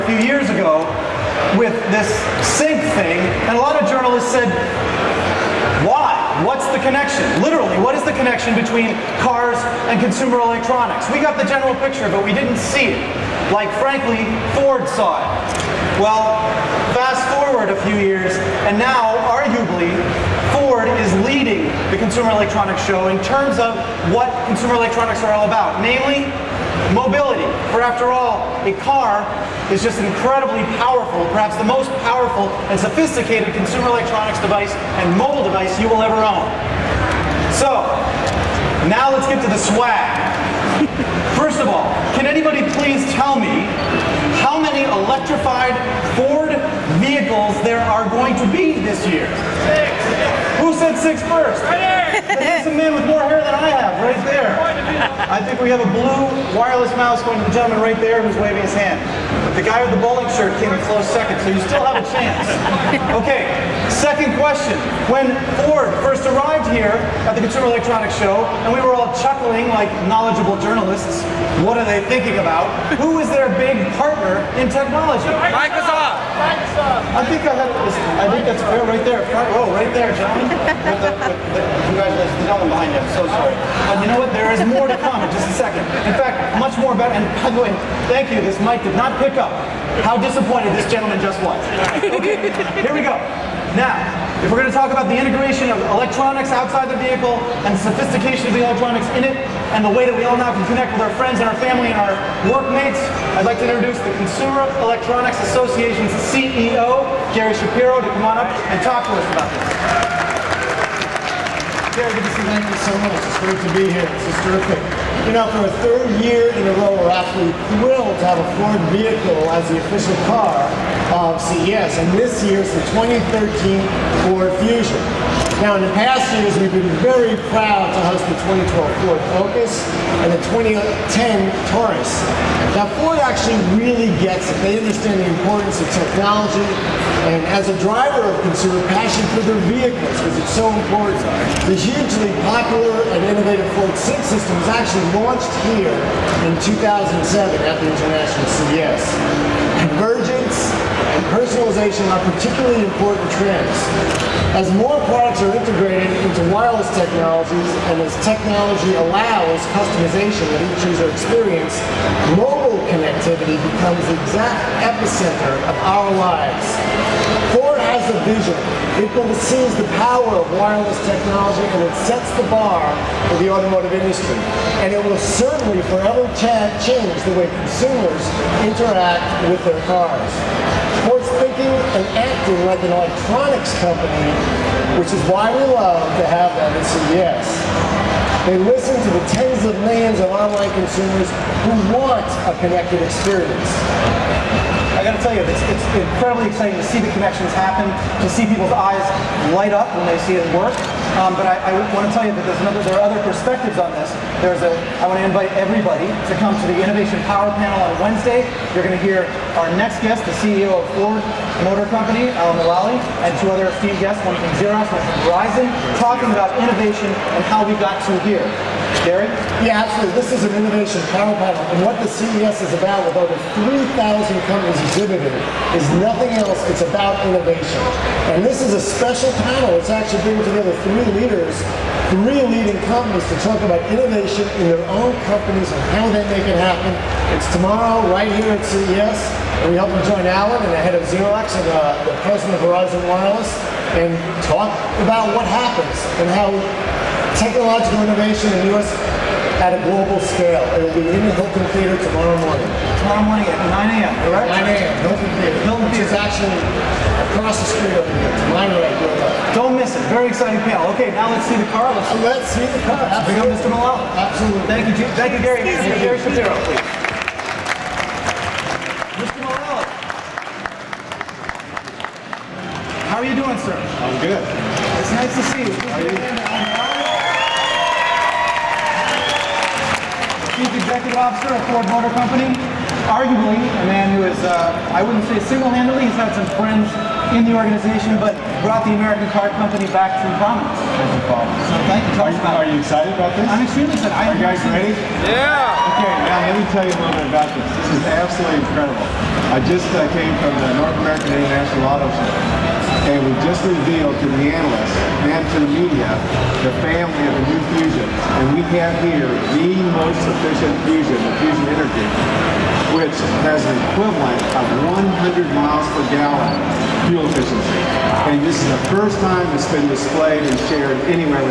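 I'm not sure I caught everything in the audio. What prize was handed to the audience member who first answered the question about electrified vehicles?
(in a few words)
blue wireless mouse.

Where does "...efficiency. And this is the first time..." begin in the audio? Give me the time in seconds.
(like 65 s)
317 s.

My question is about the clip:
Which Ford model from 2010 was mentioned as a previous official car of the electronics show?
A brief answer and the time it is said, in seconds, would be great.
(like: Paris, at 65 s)
Taurus, at 131 s.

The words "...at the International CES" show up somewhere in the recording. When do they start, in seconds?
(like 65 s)
147 s.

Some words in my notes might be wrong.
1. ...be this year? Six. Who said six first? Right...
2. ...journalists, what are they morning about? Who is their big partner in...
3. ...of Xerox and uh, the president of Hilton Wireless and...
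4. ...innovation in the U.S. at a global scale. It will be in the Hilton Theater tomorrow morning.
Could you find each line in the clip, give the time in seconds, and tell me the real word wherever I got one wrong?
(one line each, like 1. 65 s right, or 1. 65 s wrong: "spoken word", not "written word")
1. 48 s right
2. 70 s wrong: "thinking", not "morning"
3. 240 s wrong: "Verizon", not "Hilton"
4. 248 s right.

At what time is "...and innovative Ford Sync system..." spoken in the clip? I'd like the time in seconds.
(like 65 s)
143 s.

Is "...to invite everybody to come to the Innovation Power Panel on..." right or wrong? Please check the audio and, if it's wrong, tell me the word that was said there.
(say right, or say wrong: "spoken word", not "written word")
right.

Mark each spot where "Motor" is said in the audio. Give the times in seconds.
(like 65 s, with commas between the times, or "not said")
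211 s, 281 s.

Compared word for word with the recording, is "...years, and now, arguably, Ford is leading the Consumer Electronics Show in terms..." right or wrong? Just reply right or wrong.
right.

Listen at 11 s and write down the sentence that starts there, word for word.
We got the general picture, but we didn't see it.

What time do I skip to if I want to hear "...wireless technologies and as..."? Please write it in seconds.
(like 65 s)
156 s.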